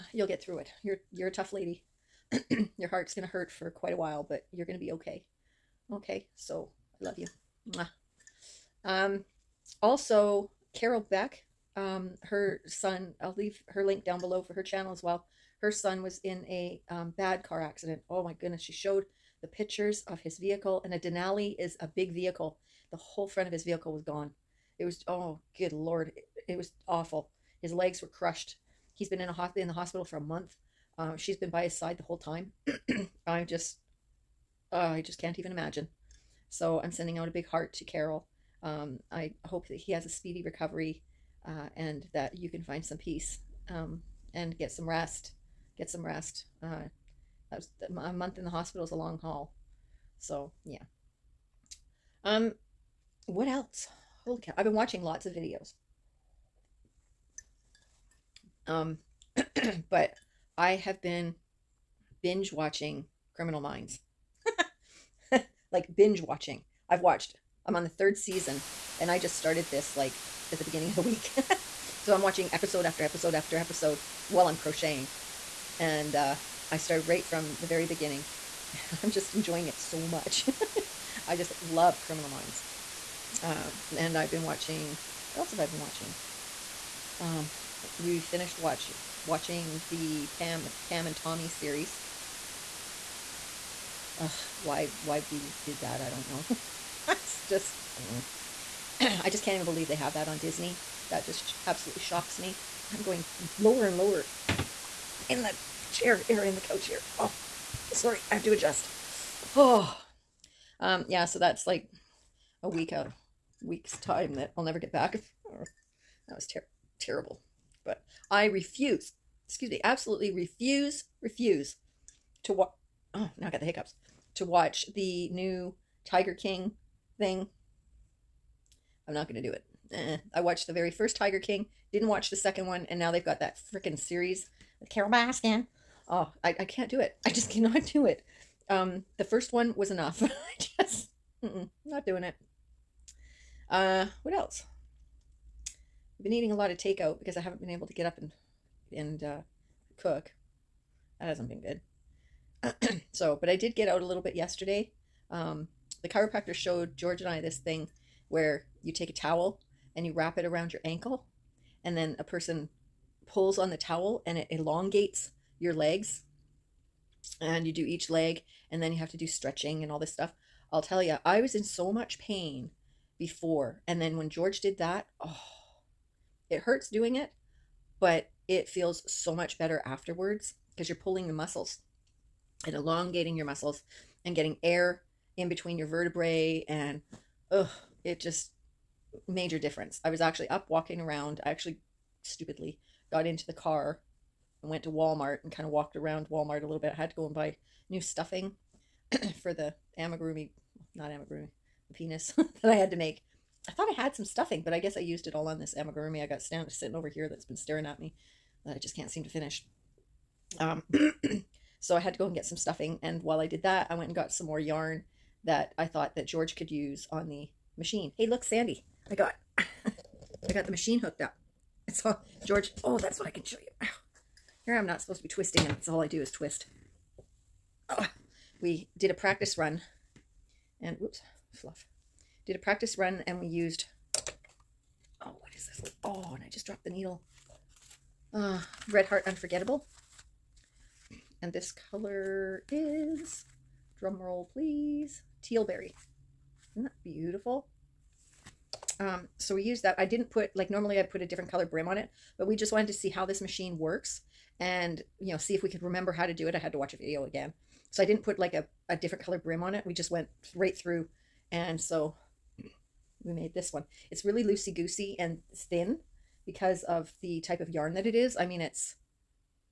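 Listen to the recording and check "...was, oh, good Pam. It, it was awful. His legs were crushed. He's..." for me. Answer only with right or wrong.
wrong.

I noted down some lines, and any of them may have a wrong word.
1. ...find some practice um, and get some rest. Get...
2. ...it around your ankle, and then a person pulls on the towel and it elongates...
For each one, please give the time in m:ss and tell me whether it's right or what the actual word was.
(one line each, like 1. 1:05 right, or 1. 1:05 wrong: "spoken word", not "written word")
1. 0:42 wrong: "peace", not "practice"
2. 2:40 right.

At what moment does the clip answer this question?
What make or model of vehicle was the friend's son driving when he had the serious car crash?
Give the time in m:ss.
0:20.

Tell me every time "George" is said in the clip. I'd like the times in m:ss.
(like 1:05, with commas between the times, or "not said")
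2:36, 2:54, 3:36, 3:42.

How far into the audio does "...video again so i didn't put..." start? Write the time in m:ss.
4:16.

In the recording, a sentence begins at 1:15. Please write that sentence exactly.
And uh, I started right from the very beginning.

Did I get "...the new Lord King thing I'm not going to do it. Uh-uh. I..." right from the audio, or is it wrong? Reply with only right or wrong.
wrong.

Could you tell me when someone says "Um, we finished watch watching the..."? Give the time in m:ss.
1:27.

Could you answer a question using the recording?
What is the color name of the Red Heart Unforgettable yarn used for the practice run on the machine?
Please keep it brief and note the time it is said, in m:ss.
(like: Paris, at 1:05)
tealberry, at 4:05.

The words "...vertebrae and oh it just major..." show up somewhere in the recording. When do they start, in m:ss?
3:05.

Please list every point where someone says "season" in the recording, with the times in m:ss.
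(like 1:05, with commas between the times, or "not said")
1:08.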